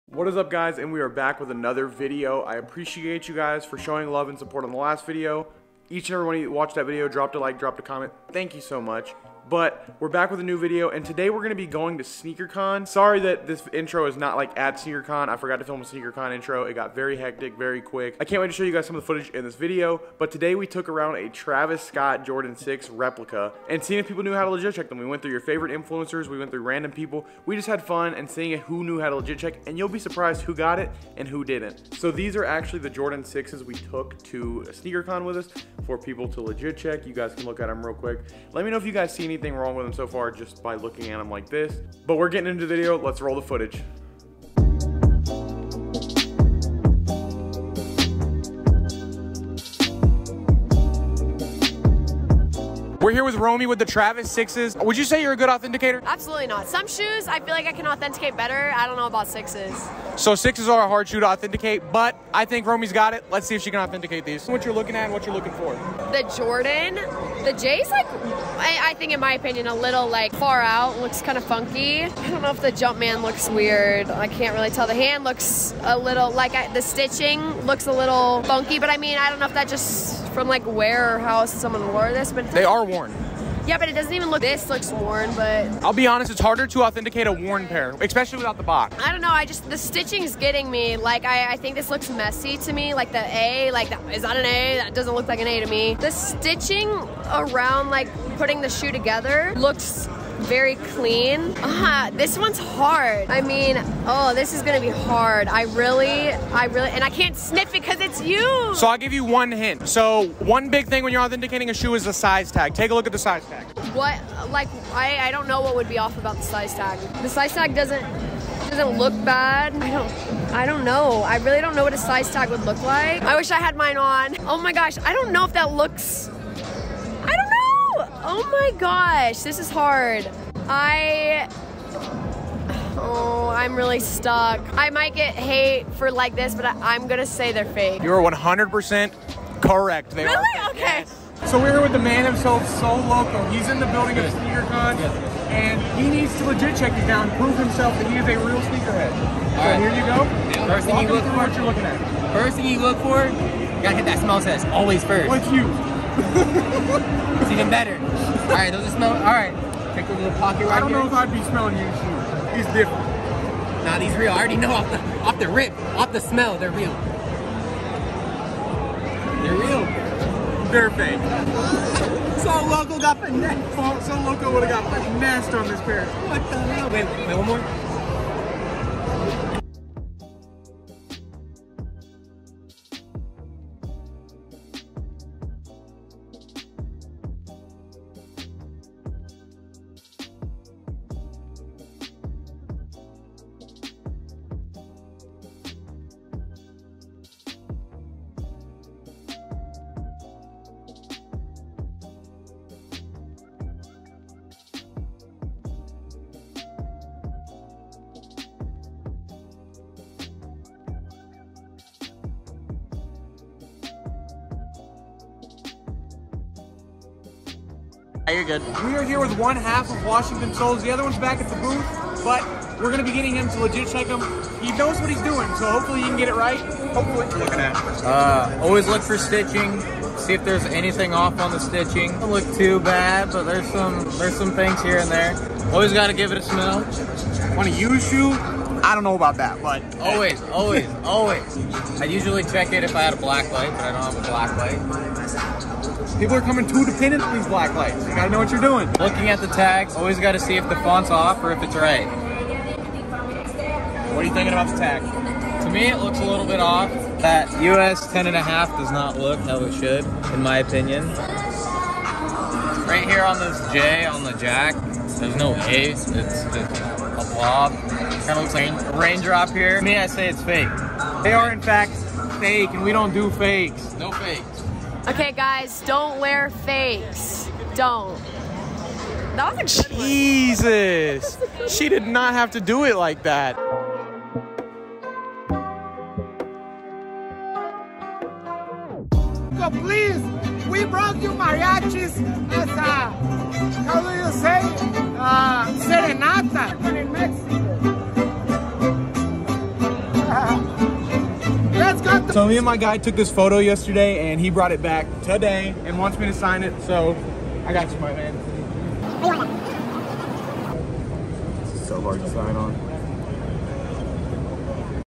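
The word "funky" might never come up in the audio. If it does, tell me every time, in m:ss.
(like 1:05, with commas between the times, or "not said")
1:11, 1:18.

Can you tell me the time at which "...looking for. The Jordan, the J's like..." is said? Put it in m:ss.
1:05.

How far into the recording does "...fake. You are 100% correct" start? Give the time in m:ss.
2:17.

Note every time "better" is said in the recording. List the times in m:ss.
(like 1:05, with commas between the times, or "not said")
0:58, 2:37.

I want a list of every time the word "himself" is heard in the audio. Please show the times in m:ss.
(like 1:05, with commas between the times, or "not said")
2:22, 2:27.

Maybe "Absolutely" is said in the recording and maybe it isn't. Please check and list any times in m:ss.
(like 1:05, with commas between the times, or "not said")
0:56.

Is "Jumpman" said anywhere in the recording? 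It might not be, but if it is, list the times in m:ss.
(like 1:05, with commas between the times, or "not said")
1:12.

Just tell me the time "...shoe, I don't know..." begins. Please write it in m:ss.
3:57.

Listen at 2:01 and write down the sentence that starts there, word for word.
I really don't know what a size tag would look like.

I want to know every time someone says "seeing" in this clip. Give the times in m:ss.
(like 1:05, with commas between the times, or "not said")
0:23, 0:28.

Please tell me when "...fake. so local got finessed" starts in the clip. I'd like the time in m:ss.
2:50.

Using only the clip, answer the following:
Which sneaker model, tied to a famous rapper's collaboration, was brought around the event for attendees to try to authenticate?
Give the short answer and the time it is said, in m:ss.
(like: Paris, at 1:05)
Travis Scott Jordan 6, at 0:21.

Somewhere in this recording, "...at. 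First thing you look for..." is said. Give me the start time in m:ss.
2:31.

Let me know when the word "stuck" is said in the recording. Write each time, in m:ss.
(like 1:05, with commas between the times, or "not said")
2:13.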